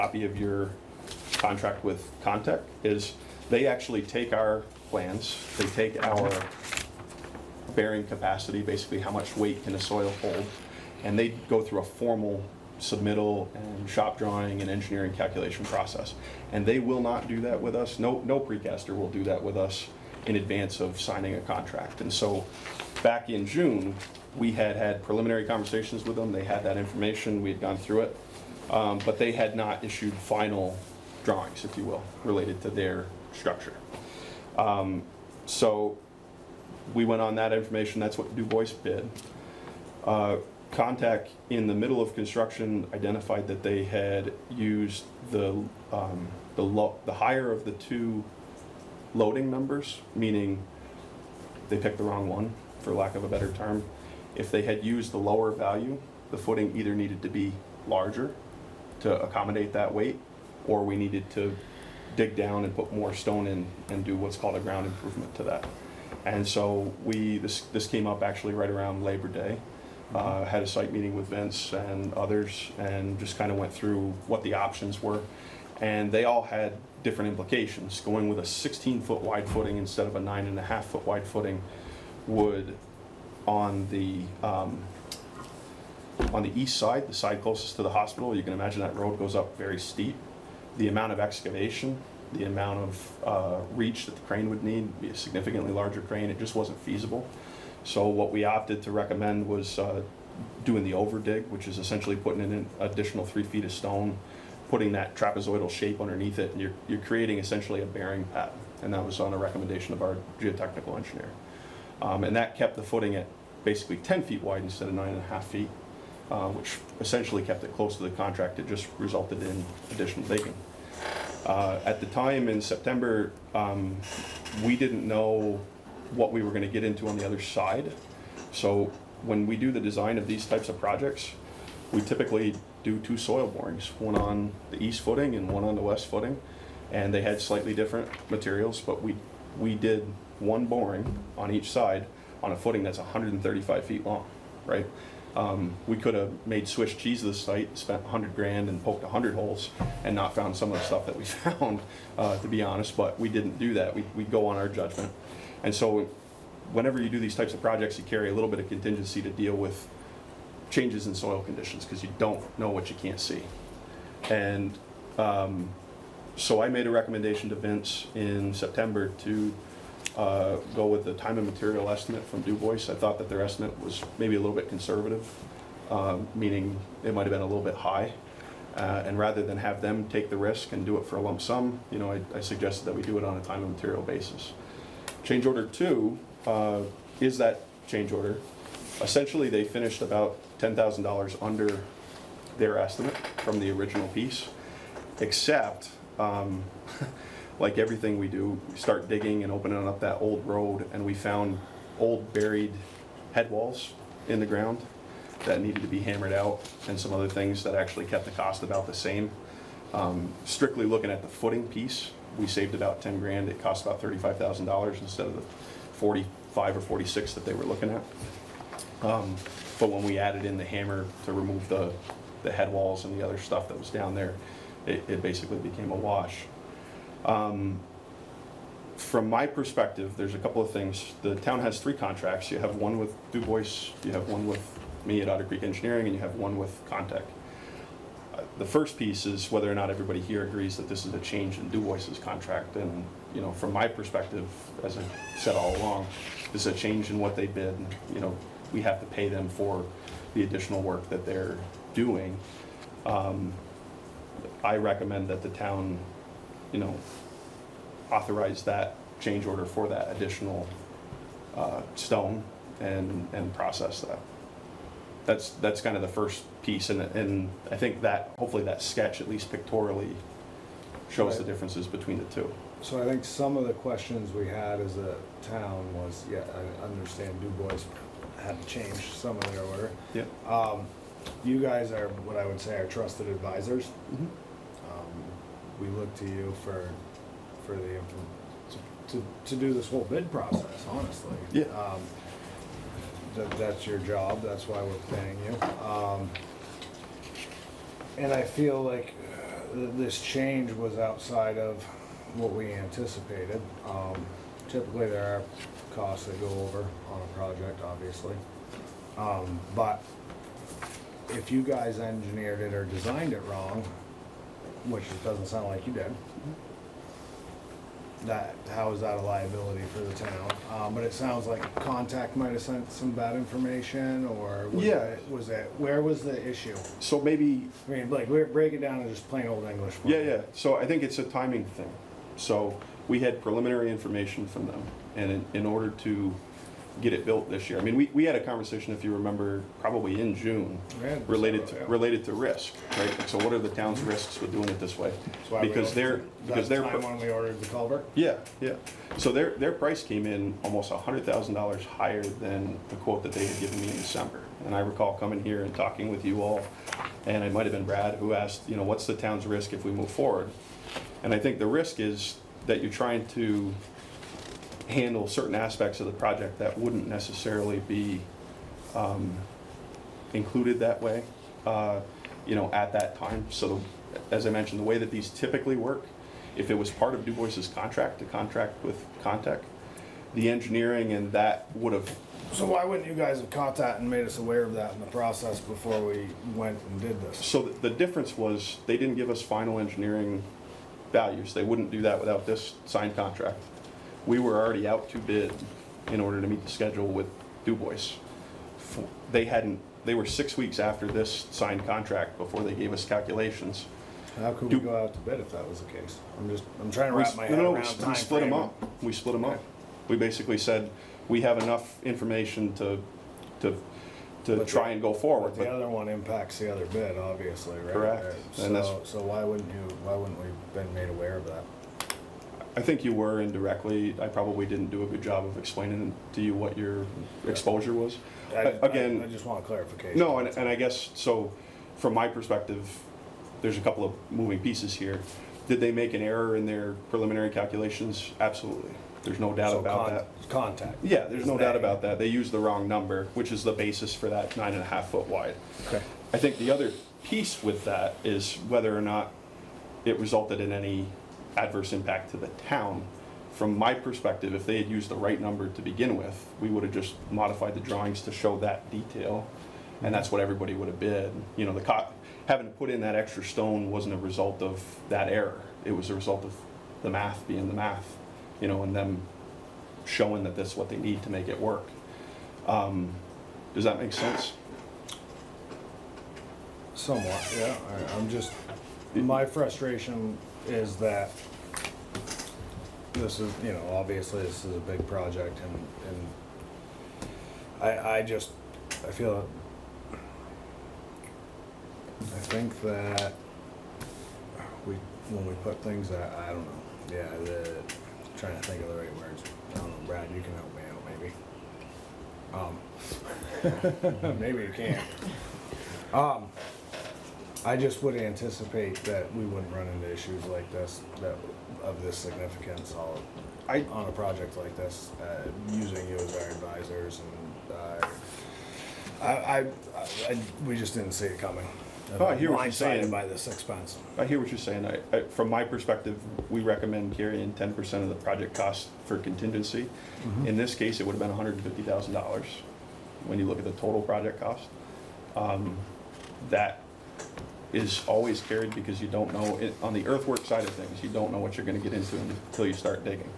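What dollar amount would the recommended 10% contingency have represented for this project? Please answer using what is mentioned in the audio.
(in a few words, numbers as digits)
$150,000.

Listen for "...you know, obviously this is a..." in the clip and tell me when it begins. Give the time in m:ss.
8:03.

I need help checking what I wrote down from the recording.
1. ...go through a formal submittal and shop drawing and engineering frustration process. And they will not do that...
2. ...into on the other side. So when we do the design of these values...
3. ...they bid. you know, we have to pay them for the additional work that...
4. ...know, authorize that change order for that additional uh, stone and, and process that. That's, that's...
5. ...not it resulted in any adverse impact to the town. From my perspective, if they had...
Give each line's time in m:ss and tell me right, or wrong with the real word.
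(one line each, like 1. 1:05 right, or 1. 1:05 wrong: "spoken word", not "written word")
1. 0:11 wrong: "calculation", not "frustration"
2. 2:06 wrong: "types", not "values"
3. 4:07 right
4. 4:16 right
5. 7:29 right.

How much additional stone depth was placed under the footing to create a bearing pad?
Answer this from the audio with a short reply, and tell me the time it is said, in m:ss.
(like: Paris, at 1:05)
3 feet, at 1:43.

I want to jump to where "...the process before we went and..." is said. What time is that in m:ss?
6:25.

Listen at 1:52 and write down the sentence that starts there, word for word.
Um, and that kept the footing at basically 10 feet wide instead of nine and a half feet.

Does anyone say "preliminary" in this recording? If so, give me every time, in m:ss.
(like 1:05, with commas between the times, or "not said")
0:25, 5:33, 7:17.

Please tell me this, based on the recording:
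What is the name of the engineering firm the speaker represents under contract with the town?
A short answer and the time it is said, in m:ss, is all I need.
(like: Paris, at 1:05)
Otter Creek Engineering, at 3:55.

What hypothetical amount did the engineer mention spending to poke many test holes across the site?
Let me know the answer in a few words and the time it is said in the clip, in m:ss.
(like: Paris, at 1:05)
$100,000, at 2:28.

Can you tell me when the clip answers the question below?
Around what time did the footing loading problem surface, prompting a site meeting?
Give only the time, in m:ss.
1:09.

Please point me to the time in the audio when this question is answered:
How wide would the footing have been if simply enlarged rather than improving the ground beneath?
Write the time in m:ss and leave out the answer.
1:18.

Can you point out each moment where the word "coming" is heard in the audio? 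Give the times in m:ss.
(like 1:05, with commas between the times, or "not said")
5:55, 8:41.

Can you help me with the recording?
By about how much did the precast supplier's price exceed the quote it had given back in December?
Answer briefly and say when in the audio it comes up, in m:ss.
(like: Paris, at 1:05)
$100,000, at 5:50.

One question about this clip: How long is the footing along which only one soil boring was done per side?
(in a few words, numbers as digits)
135 feet.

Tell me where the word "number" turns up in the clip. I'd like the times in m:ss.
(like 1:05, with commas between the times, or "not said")
0:49, 7:22, 7:35.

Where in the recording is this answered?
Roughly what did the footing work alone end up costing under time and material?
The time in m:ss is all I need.
3:34.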